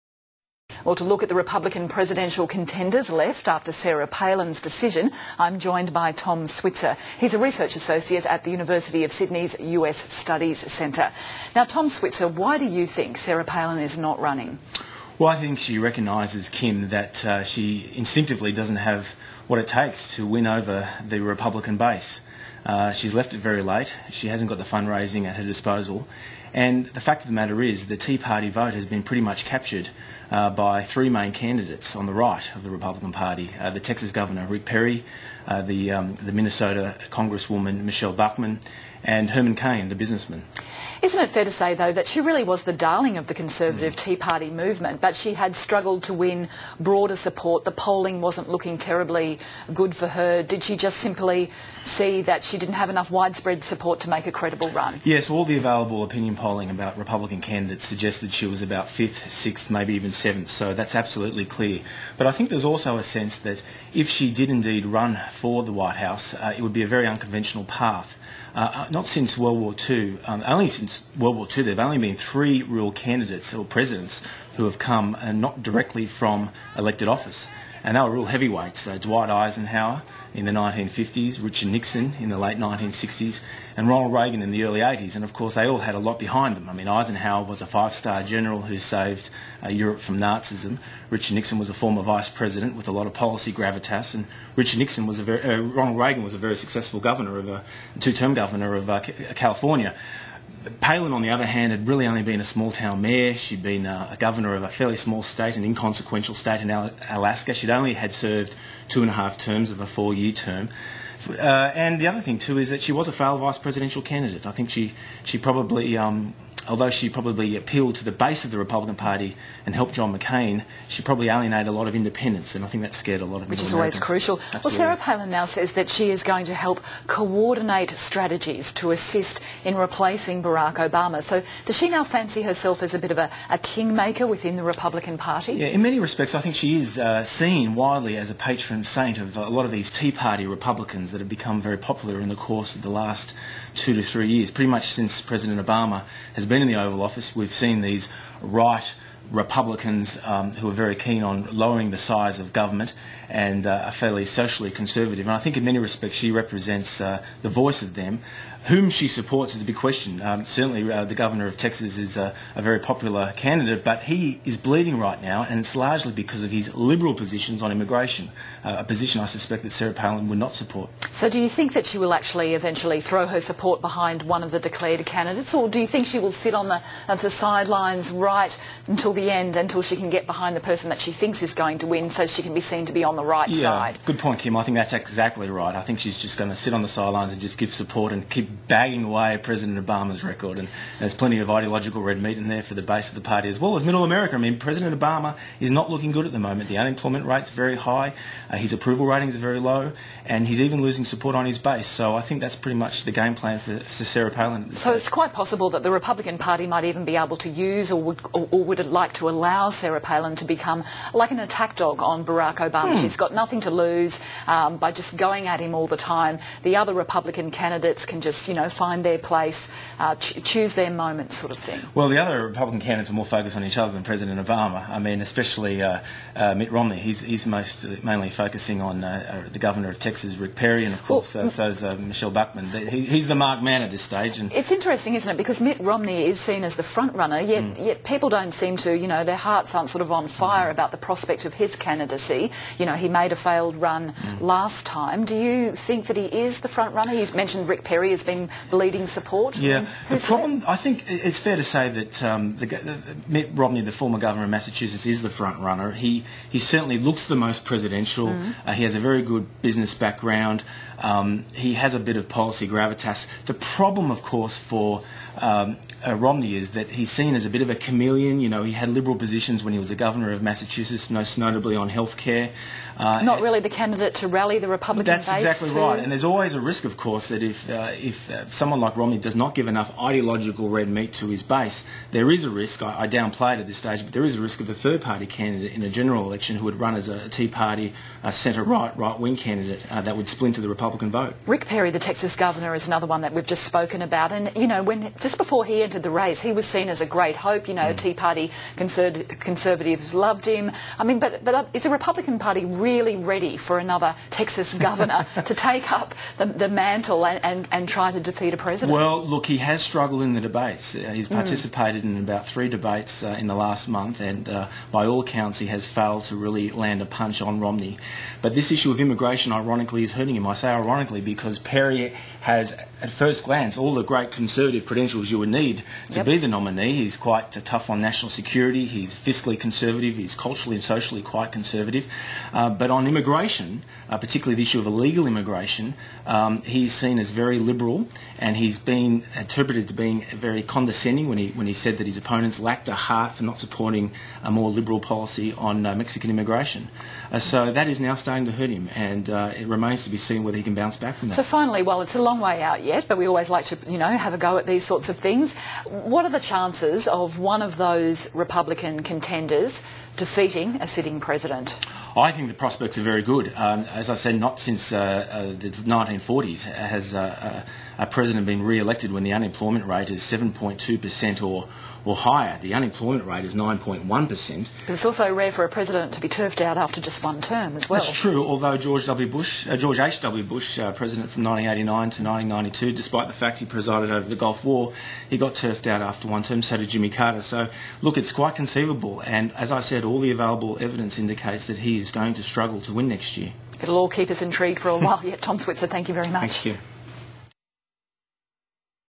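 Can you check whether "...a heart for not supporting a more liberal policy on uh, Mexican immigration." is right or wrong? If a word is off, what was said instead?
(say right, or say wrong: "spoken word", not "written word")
right.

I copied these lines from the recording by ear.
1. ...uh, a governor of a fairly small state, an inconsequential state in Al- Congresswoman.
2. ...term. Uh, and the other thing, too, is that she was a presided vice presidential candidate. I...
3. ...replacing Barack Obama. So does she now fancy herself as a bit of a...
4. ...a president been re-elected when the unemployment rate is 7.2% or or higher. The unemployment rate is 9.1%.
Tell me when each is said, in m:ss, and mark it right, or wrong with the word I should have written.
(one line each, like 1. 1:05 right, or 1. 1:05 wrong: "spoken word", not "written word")
1. 1:43 wrong: "Alaska", not "Congresswoman"
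2. 1:50 wrong: "failed", not "presided"
3. 2:09 right
4. 6:08 right.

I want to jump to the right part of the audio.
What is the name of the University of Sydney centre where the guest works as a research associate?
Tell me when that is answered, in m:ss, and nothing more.
0:09.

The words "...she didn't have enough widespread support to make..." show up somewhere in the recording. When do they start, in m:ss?
0:52.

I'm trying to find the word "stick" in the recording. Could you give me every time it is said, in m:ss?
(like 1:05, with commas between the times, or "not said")
not said.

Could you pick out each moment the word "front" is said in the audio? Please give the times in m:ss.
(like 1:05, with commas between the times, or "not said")
3:56, 4:06, 4:15.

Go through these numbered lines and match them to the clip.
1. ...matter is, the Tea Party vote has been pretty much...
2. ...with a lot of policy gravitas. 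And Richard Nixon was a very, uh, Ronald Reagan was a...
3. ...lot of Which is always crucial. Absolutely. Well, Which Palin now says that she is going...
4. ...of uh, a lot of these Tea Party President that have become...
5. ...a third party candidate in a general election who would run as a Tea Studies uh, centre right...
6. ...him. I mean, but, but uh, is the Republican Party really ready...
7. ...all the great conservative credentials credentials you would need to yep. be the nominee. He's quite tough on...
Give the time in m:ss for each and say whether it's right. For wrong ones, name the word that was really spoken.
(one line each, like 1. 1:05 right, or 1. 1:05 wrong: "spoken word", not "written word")
1. 0:27 right
2. 1:32 right
3. 2:03 wrong: "Sarah", not "Which"
4. 2:19 wrong: "Republicans", not "President"
5. 4:44 wrong: "Party", not "Studies"
6. 5:00 right
7. 5:23 right.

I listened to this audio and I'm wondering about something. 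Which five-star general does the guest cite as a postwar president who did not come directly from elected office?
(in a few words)
Dwight Eisenhower.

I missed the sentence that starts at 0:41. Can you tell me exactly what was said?
Isn't it fair to say, though, that she really was the darling of the Conservative mm.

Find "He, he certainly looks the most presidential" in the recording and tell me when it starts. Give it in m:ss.
4:15.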